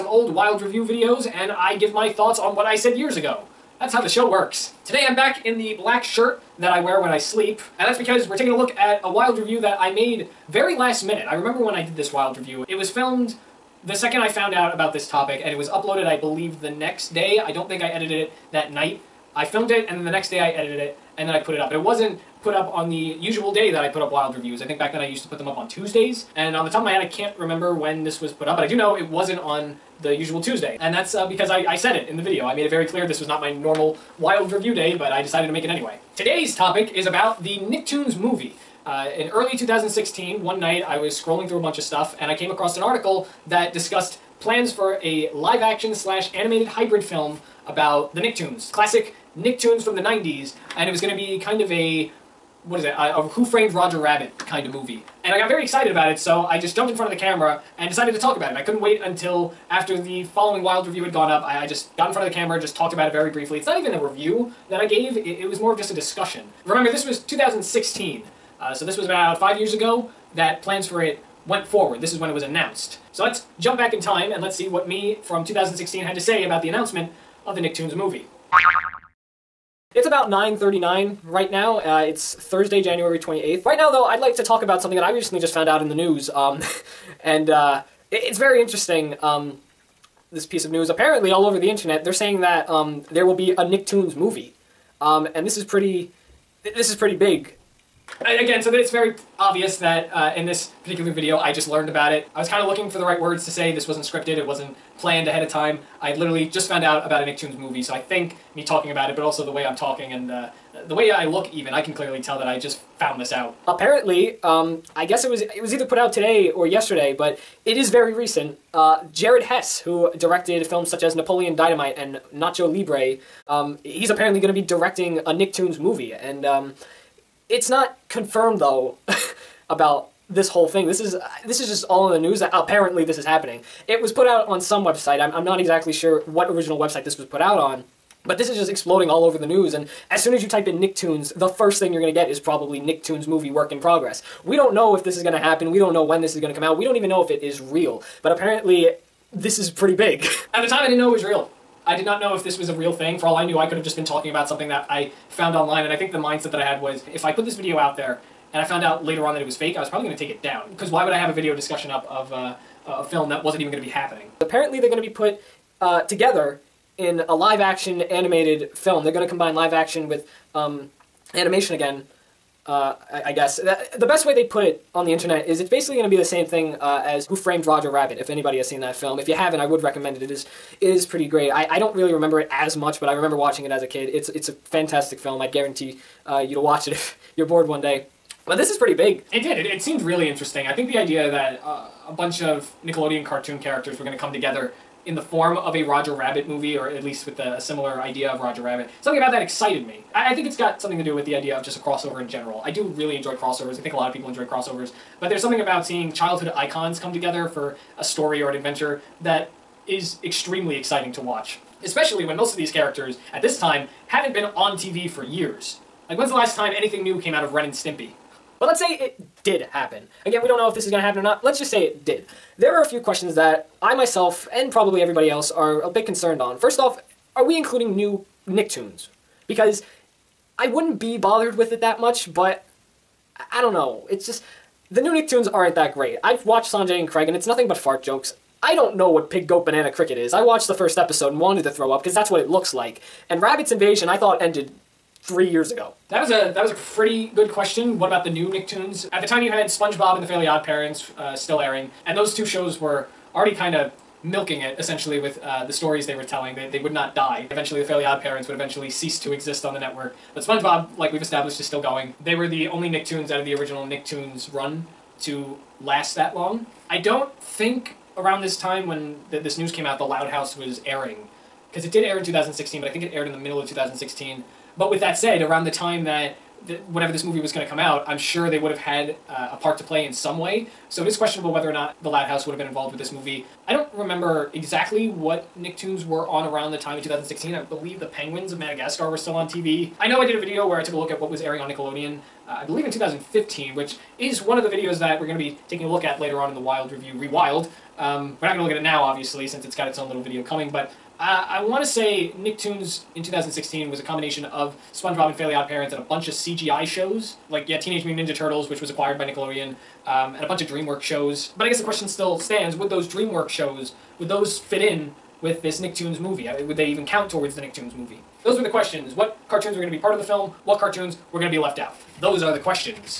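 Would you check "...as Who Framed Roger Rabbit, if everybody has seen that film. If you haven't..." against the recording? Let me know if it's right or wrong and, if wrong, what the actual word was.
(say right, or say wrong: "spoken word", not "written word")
wrong: "anybody", not "everybody".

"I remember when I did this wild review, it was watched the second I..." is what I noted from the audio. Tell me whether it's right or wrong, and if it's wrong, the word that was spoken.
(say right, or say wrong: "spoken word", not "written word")
wrong: "filmed", not "watched".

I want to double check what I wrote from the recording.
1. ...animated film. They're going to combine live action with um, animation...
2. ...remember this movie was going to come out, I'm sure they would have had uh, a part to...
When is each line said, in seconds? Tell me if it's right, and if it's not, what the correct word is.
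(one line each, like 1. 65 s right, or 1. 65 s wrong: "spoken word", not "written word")
1. 168 s right
2. 276 s wrong: "whenever", not "remember".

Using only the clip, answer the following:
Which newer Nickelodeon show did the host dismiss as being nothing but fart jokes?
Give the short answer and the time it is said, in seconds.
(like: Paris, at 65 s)
Sanjay and Craig, at 236 s.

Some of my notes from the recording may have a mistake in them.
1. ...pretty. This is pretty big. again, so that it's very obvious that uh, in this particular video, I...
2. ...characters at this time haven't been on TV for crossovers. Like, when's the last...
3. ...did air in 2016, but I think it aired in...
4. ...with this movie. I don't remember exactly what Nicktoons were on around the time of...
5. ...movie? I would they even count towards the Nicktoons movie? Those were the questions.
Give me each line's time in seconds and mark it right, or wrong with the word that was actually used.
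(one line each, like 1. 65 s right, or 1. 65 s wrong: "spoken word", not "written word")
1. 95 s right
2. 212 s wrong: "years", not "crossovers"
3. 271 s right
4. 282 s right
5. 316 s right.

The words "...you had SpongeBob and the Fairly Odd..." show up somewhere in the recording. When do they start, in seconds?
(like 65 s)
249 s.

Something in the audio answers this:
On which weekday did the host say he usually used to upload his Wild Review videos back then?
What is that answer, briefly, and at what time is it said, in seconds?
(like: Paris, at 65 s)
Tuesdays, at 25 s.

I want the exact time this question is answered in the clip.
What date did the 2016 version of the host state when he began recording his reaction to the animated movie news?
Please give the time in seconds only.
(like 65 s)
82 s.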